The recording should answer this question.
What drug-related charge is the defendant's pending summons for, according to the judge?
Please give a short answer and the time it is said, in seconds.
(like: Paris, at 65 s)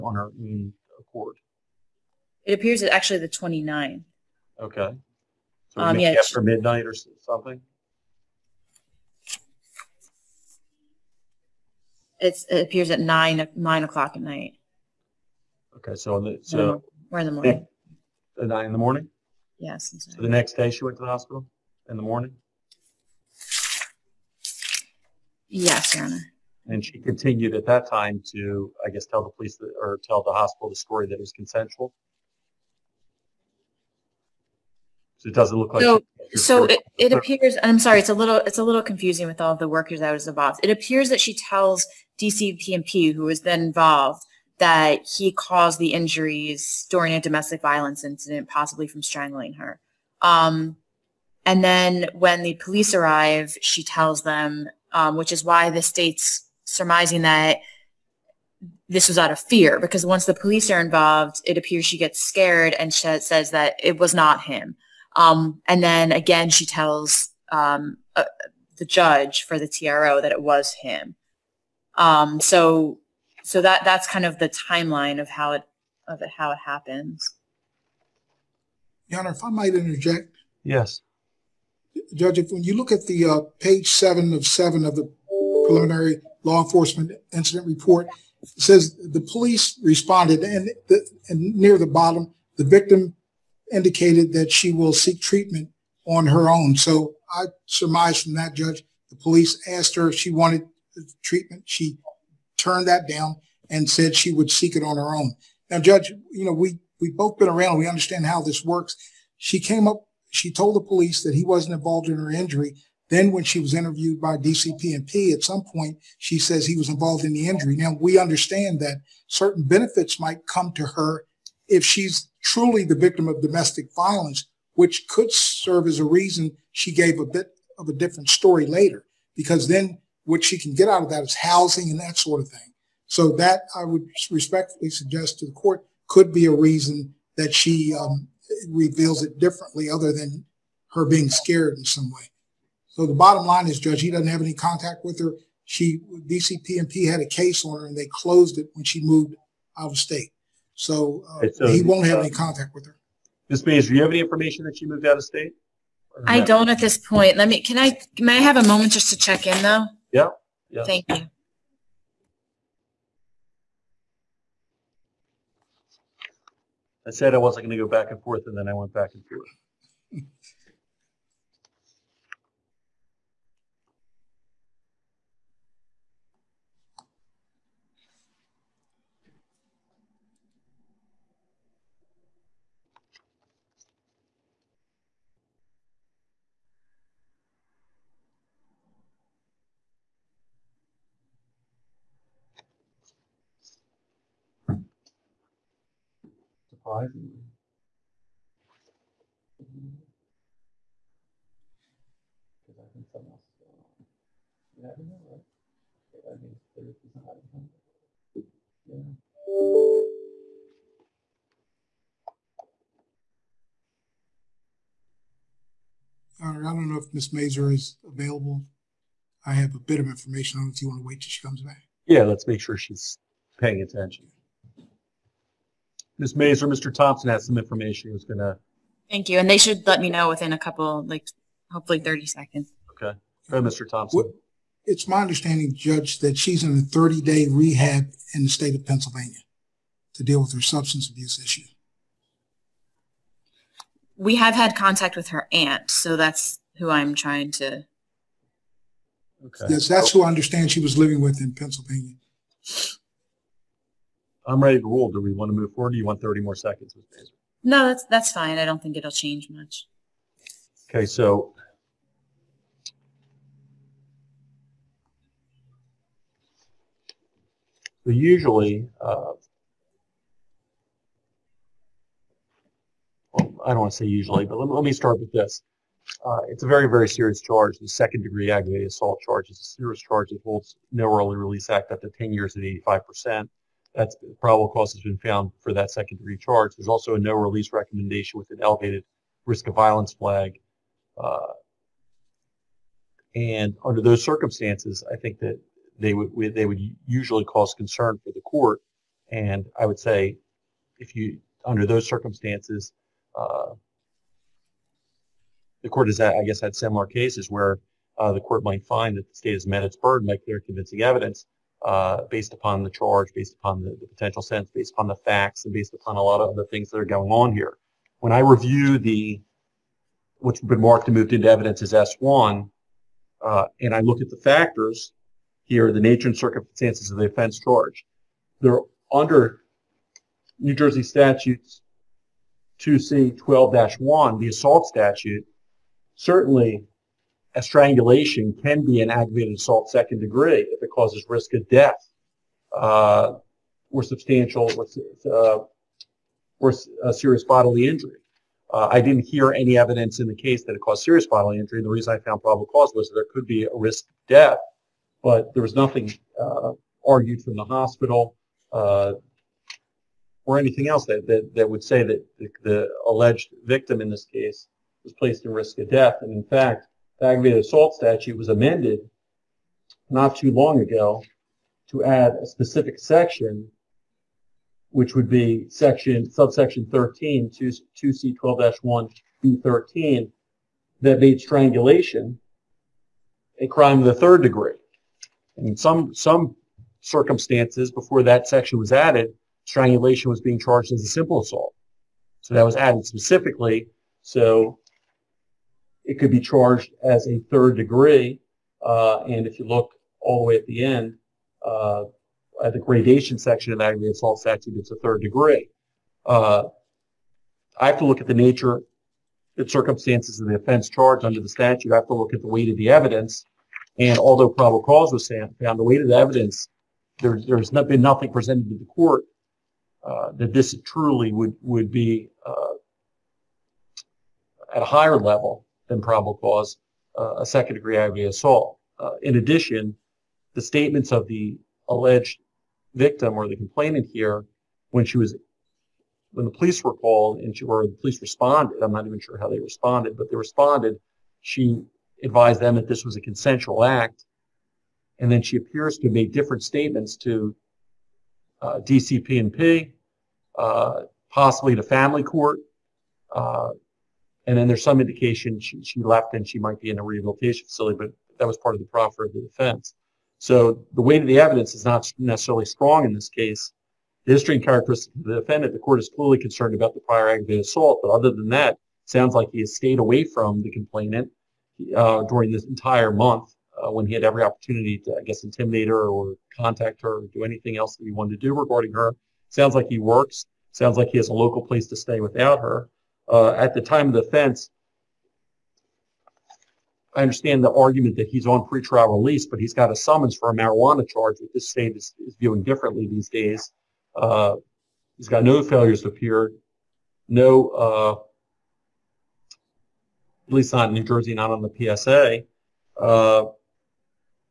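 Marijuana, at 490 s.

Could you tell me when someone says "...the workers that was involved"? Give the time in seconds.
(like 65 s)
39 s.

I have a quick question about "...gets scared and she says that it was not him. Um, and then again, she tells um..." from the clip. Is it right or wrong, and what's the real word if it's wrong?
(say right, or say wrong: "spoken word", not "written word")
right.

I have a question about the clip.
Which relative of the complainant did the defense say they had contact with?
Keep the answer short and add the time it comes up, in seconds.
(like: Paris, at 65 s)
Her aunt, at 245 s.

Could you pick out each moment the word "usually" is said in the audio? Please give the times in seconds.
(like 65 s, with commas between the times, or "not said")
268 s, 274 s, 297 s.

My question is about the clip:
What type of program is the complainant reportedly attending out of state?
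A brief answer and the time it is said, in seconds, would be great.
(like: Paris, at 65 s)
30 day rehab, at 236 s.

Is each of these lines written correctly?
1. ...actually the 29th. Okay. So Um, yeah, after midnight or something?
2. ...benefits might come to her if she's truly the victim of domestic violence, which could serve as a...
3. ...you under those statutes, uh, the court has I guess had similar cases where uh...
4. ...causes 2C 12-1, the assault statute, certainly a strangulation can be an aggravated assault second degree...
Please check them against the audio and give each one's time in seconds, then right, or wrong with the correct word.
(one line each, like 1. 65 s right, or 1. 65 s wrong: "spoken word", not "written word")
1. 2 s right
2. 119 s right
3. 301 s wrong: "circumstances", not "statutes"
4. 331 s wrong: "statutes", not "causes".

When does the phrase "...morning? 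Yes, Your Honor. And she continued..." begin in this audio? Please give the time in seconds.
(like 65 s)
22 s.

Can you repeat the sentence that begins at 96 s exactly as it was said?
So I surmise from that, Judge, the police asked her if she wanted treatment.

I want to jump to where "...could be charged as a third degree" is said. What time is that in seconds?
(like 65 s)
396 s.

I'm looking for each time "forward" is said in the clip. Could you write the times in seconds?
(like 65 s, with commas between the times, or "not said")
255 s.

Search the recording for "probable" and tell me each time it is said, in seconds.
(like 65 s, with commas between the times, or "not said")
284 s, 352 s, 414 s, 426 s.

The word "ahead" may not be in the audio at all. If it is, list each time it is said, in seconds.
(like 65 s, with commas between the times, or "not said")
233 s.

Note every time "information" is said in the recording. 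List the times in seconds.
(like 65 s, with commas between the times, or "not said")
154 s, 220 s, 227 s.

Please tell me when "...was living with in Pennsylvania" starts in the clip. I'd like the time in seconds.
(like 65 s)
250 s.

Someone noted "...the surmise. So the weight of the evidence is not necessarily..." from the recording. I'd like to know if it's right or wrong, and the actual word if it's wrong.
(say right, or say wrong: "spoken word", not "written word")
wrong: "defense", not "surmise".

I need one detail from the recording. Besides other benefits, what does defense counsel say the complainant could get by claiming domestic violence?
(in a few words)
Housing.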